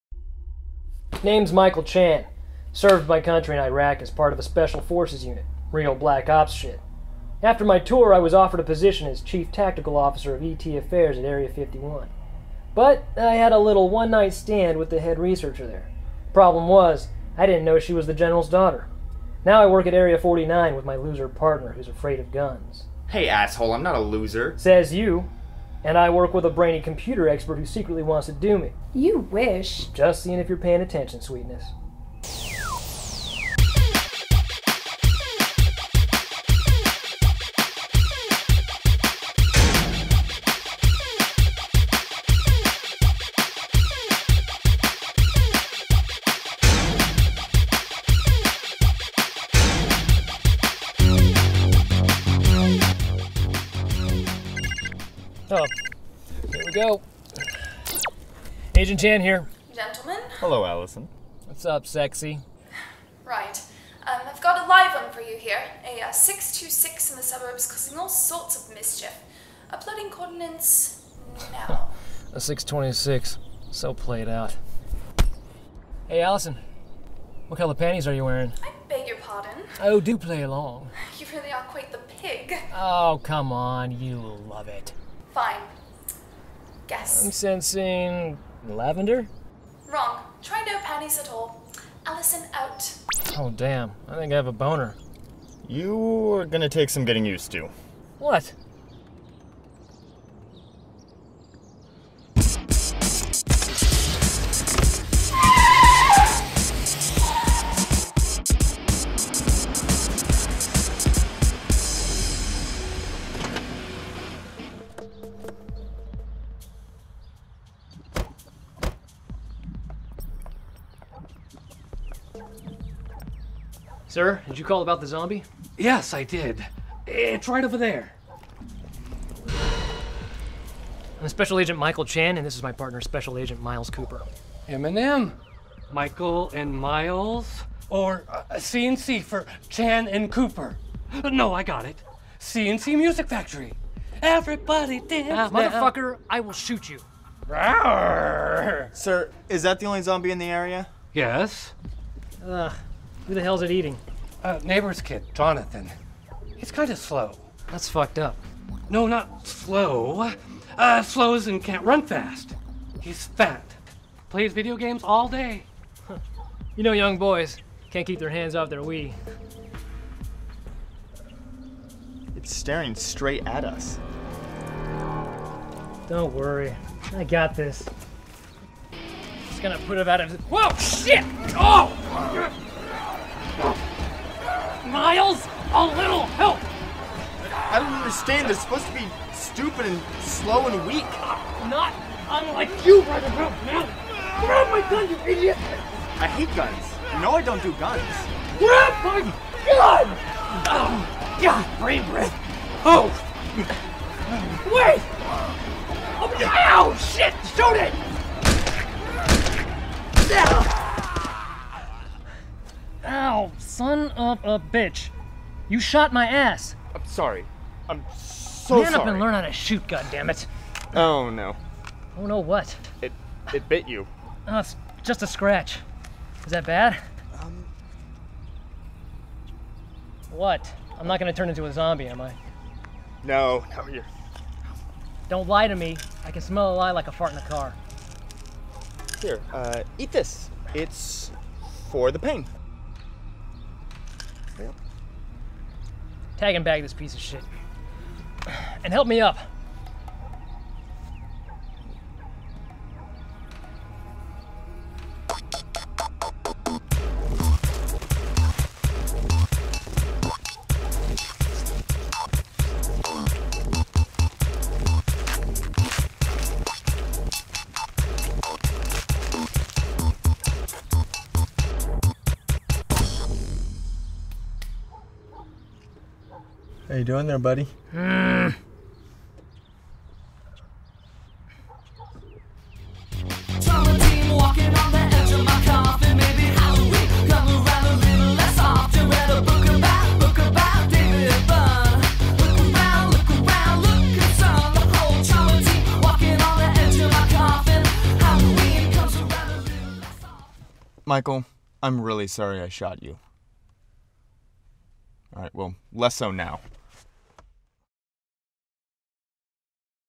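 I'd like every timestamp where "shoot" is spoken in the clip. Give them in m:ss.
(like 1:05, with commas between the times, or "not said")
2:26, 3:27, 3:39.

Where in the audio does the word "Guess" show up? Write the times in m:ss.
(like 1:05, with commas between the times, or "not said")
1:26.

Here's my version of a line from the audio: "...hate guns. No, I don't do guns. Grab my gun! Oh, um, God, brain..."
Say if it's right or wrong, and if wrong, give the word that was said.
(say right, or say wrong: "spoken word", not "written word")
right.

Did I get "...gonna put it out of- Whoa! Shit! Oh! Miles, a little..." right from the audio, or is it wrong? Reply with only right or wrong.
right.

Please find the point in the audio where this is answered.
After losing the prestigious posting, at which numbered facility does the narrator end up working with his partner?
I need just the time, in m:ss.
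0:19.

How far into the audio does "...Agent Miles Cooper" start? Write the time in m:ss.
2:13.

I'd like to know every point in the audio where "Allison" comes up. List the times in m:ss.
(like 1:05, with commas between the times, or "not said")
1:00, 1:16, 1:32.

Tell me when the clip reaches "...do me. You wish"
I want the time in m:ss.
0:28.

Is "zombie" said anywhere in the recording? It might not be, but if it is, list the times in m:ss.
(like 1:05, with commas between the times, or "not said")
2:05, 2:30, 3:51.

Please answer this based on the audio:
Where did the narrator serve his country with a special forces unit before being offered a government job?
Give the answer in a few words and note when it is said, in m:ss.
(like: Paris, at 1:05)
Iraq, at 0:03.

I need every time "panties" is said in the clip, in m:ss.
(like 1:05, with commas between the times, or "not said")
1:17, 1:30.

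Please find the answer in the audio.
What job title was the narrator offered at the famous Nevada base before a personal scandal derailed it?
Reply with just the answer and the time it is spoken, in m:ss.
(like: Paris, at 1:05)
Chief Tactical Officer of ET Affairs, at 0:09.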